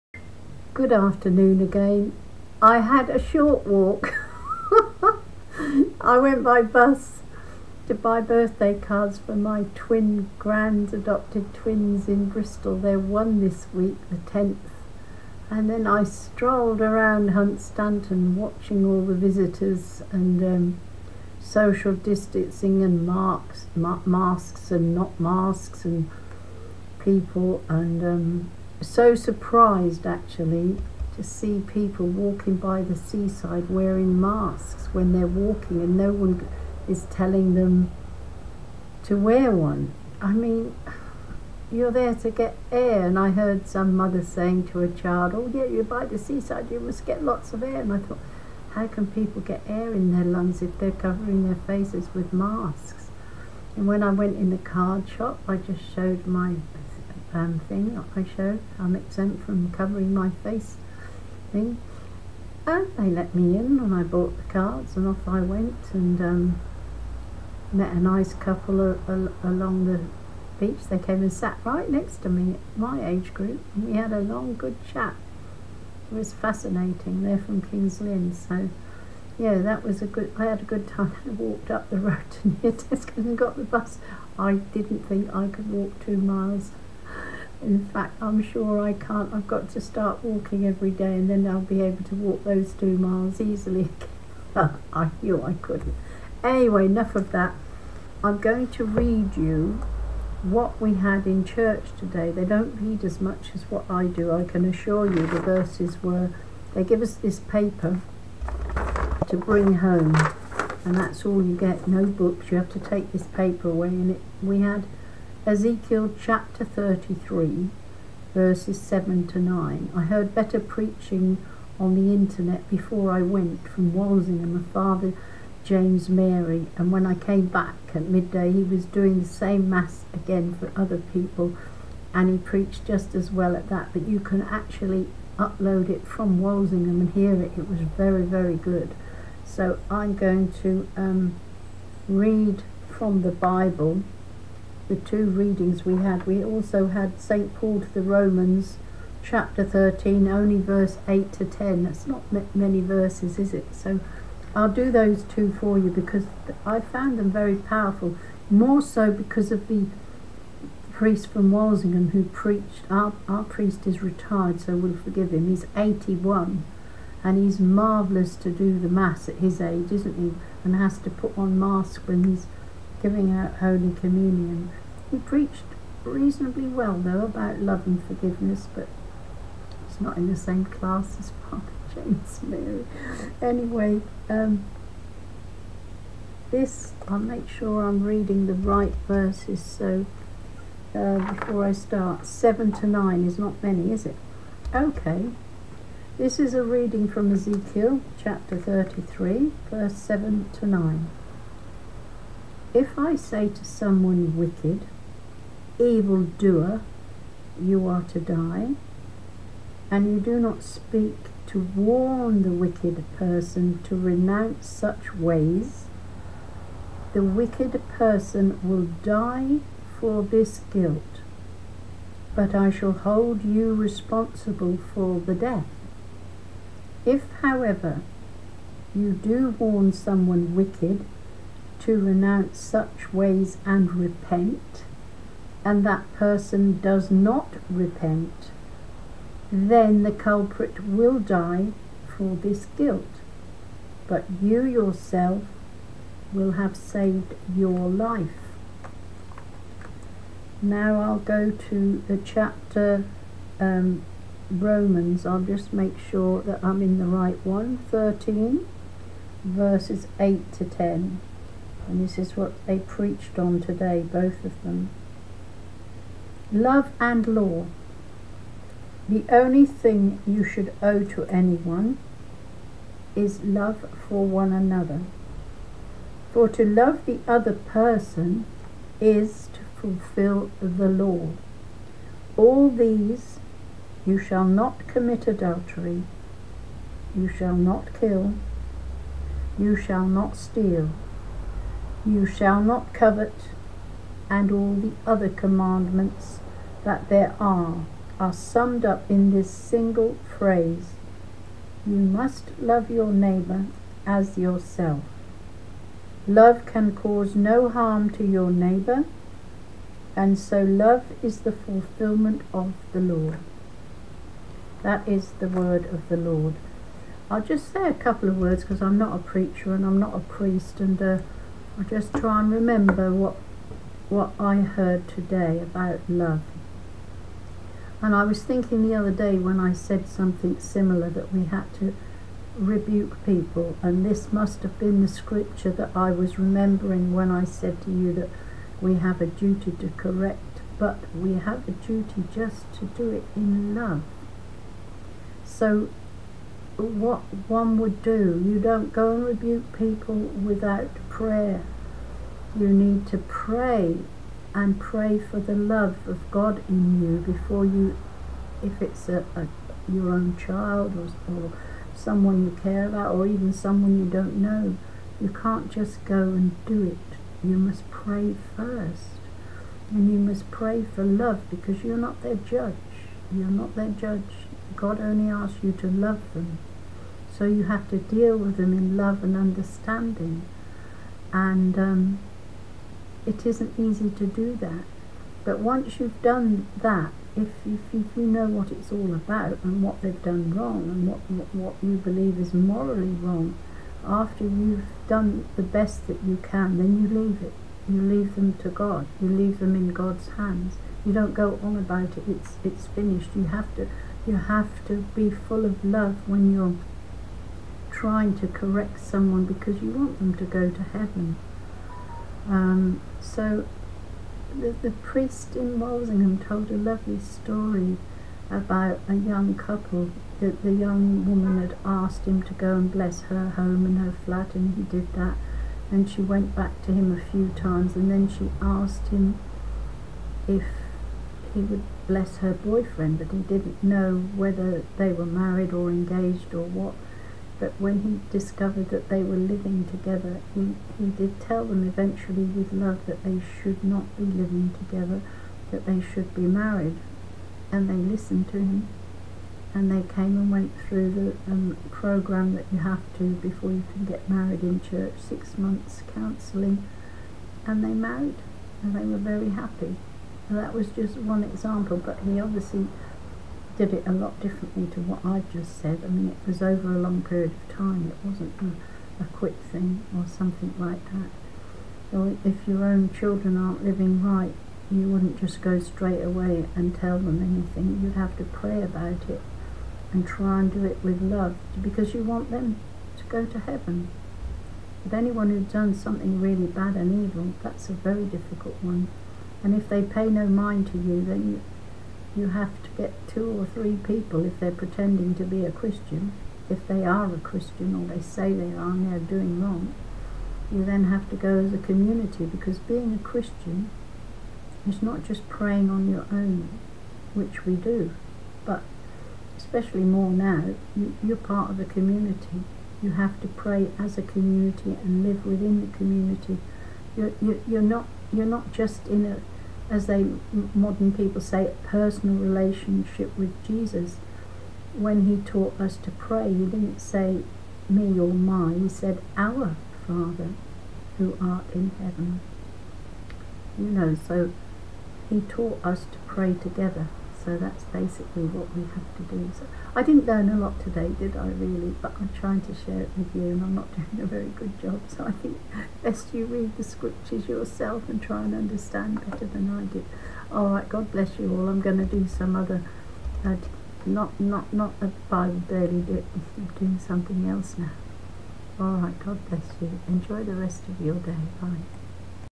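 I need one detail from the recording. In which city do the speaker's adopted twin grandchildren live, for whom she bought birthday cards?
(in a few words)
Bristol.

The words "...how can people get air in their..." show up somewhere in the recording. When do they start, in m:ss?
0:48.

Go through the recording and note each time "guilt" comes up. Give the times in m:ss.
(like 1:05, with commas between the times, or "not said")
3:40, 4:02.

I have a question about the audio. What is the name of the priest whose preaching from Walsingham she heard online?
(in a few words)
Father James Mary.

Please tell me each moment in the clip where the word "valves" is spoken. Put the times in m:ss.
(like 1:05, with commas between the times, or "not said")
not said.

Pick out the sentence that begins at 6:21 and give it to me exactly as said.
And um, it isn't easy to do that.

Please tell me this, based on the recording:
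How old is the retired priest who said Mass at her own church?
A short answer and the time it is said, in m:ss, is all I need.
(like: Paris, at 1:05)
81, at 2:45.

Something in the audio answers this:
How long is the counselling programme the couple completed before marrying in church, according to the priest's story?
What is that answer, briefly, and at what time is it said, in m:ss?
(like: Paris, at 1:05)
6 months, at 7:35.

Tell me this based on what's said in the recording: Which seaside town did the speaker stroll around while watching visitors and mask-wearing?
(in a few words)
Hunstanton.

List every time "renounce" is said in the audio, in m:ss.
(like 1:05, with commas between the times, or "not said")
3:33, 3:51.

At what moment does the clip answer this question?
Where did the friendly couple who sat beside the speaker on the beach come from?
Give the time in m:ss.
1:17.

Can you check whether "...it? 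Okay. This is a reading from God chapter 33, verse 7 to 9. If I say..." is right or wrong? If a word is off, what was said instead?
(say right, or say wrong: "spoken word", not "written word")
wrong: "Ezekiel", not "God".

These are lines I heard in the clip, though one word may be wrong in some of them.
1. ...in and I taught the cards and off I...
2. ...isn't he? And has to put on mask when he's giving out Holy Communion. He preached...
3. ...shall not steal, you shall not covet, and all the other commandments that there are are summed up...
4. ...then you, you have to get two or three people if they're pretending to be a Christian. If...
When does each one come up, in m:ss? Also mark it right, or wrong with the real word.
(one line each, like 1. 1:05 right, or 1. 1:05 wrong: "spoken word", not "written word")
1. 1:03 wrong: "bought", not "taught"
2. 2:49 right
3. 4:49 right
4. 8:11 right.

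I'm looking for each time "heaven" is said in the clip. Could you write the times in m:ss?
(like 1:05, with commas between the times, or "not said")
6:50, 8:03, 8:52.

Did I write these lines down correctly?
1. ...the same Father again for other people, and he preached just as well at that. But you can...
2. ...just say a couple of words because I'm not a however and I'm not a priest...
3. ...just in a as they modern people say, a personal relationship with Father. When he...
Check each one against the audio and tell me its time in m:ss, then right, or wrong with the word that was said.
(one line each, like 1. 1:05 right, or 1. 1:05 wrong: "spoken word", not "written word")
1. 2:09 wrong: "Mass", not "Father"
2. 5:17 wrong: "preacher", not "however"
3. 8:38 wrong: "Jesus", not "Father".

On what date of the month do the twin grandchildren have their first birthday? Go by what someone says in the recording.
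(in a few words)
10th.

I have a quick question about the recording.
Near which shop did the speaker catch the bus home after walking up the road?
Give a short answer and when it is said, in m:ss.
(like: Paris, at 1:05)
Tesco, at 1:22.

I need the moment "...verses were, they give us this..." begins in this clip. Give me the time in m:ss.
1:45.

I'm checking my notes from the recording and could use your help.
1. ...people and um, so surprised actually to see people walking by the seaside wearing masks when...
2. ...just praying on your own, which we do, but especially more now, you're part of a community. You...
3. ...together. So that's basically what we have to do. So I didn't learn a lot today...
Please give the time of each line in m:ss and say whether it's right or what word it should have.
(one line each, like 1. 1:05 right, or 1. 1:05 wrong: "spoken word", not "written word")
1. 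0:27 right
2. 8:25 right
3. 8:56 right.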